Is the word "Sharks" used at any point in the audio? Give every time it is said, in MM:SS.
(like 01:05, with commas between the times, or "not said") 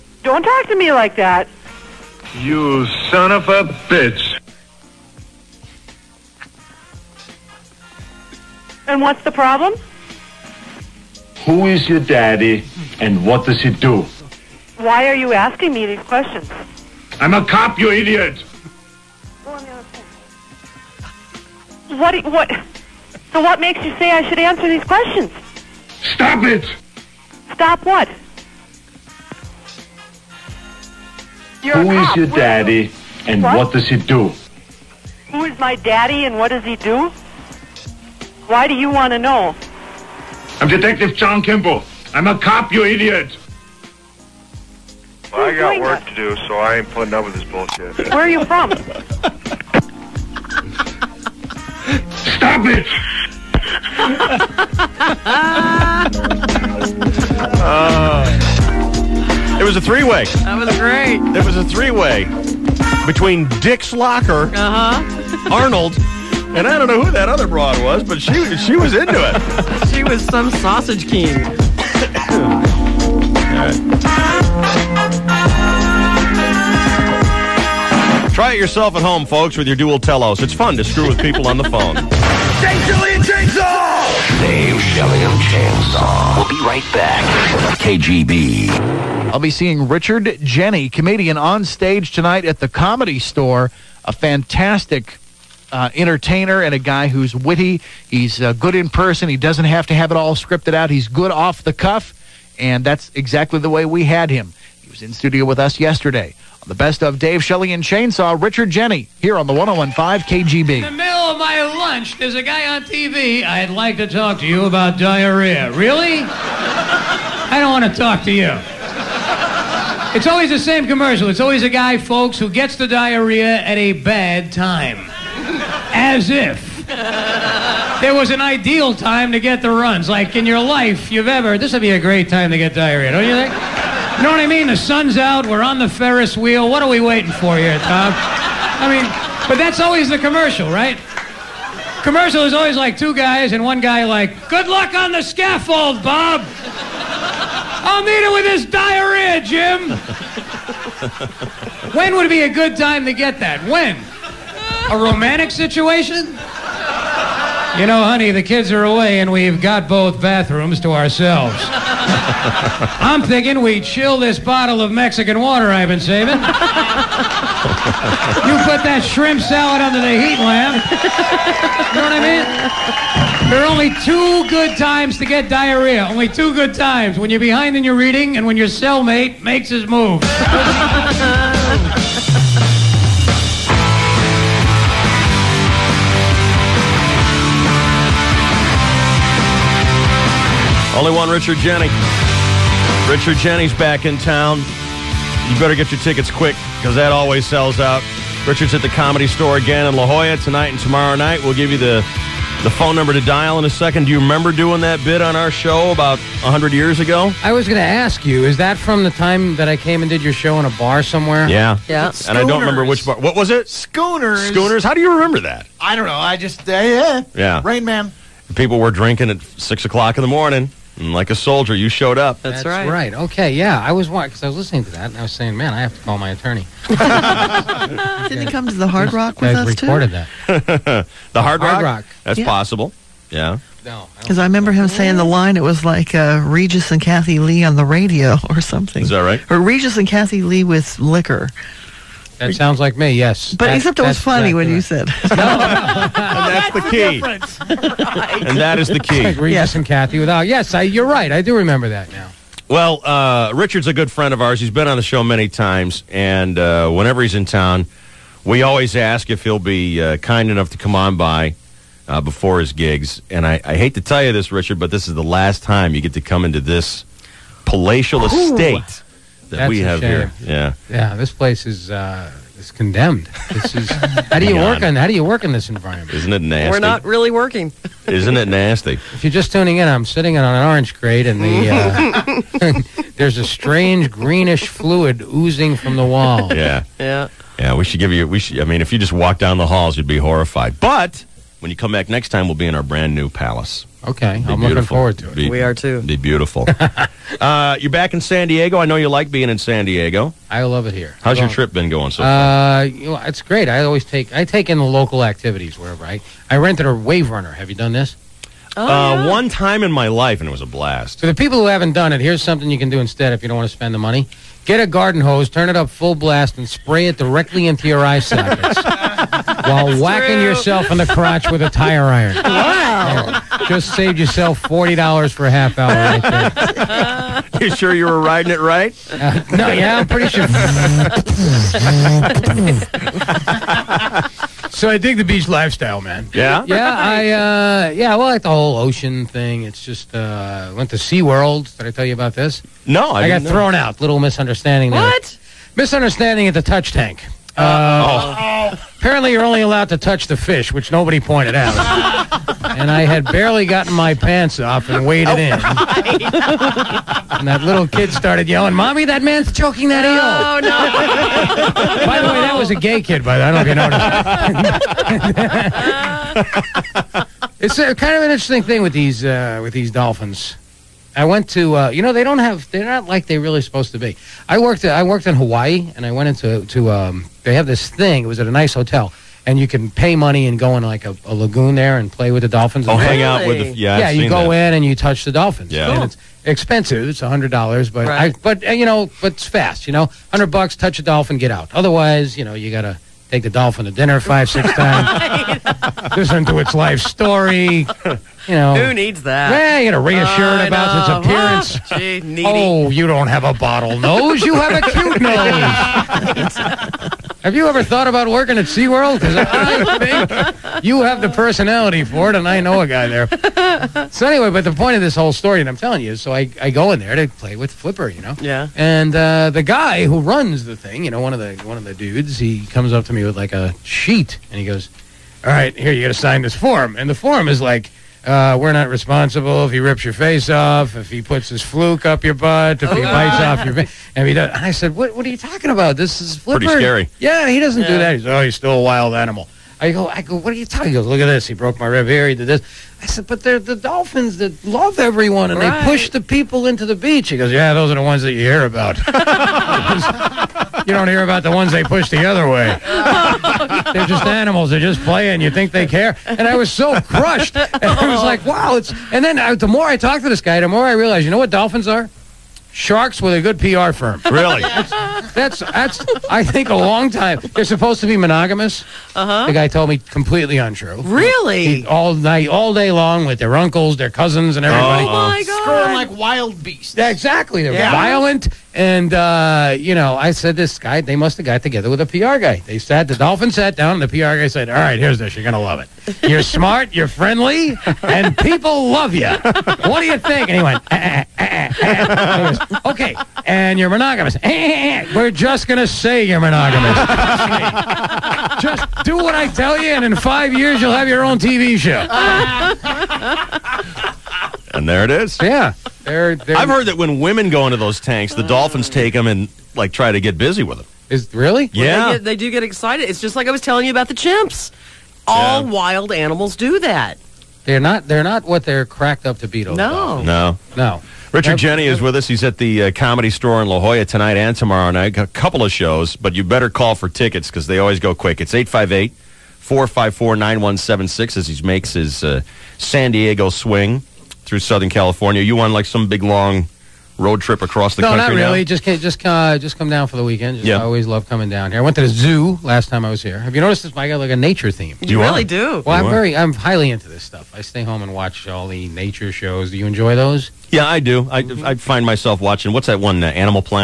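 07:42.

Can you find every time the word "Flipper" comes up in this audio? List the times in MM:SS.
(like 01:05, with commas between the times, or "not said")
06:57, 07:16.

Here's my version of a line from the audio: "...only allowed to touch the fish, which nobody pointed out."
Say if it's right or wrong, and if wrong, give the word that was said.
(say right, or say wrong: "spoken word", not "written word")
right.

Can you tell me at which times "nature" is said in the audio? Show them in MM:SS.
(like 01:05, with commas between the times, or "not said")
09:04, 09:08.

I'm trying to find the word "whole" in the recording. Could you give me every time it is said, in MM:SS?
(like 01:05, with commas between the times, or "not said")
05:38, 06:55.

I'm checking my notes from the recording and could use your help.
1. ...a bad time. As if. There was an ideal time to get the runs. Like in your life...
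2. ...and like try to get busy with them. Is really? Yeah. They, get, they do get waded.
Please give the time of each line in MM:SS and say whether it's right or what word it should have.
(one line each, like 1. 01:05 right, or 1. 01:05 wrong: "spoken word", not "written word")
1. 02:03 right
2. 08:29 wrong: "excited", not "waded".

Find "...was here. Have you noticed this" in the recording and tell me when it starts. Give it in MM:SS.
09:03.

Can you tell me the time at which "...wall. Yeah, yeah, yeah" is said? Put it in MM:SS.
04:46.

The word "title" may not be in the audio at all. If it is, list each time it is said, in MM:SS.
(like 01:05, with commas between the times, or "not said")
not said.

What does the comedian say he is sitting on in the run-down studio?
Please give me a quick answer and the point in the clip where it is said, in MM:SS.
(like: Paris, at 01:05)
an orange crate, at 04:40.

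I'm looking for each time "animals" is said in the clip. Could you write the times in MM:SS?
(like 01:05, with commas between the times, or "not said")
07:19, 07:34, 08:36, 09:13.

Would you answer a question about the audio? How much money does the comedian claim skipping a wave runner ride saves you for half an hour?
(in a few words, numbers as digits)
$40.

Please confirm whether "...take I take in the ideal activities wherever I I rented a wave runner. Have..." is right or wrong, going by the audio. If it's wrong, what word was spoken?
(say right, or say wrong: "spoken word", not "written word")
wrong: "local", not "ideal".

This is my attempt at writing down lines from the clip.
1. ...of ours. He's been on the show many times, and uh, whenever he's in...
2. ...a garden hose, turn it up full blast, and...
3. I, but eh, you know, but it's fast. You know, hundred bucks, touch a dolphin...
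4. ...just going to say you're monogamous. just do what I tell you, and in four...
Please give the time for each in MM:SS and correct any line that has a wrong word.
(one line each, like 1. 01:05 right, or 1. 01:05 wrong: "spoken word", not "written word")
1. 04:14 right
2. 05:14 right
3. 06:28 right
4. 08:15 wrong: "five", not "four".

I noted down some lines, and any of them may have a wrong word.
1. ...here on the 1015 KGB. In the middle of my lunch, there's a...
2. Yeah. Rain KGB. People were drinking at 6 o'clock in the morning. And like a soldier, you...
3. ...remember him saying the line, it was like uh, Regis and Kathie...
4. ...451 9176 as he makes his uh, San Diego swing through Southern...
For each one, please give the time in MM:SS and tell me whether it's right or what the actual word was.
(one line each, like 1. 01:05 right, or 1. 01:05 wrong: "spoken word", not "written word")
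1. 01:49 right
2. 03:37 wrong: "Man", not "KGB"
3. 03:54 right
4. 08:49 wrong: "454", not "451".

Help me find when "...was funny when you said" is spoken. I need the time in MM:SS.
04:04.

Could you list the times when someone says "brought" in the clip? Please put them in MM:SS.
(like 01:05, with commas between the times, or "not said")
not said.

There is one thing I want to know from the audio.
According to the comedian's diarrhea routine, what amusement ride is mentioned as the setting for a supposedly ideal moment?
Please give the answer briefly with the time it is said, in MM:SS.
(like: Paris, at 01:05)
Ferris wheel, at 02:15.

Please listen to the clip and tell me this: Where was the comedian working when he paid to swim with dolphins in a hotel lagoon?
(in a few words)
Hawaii.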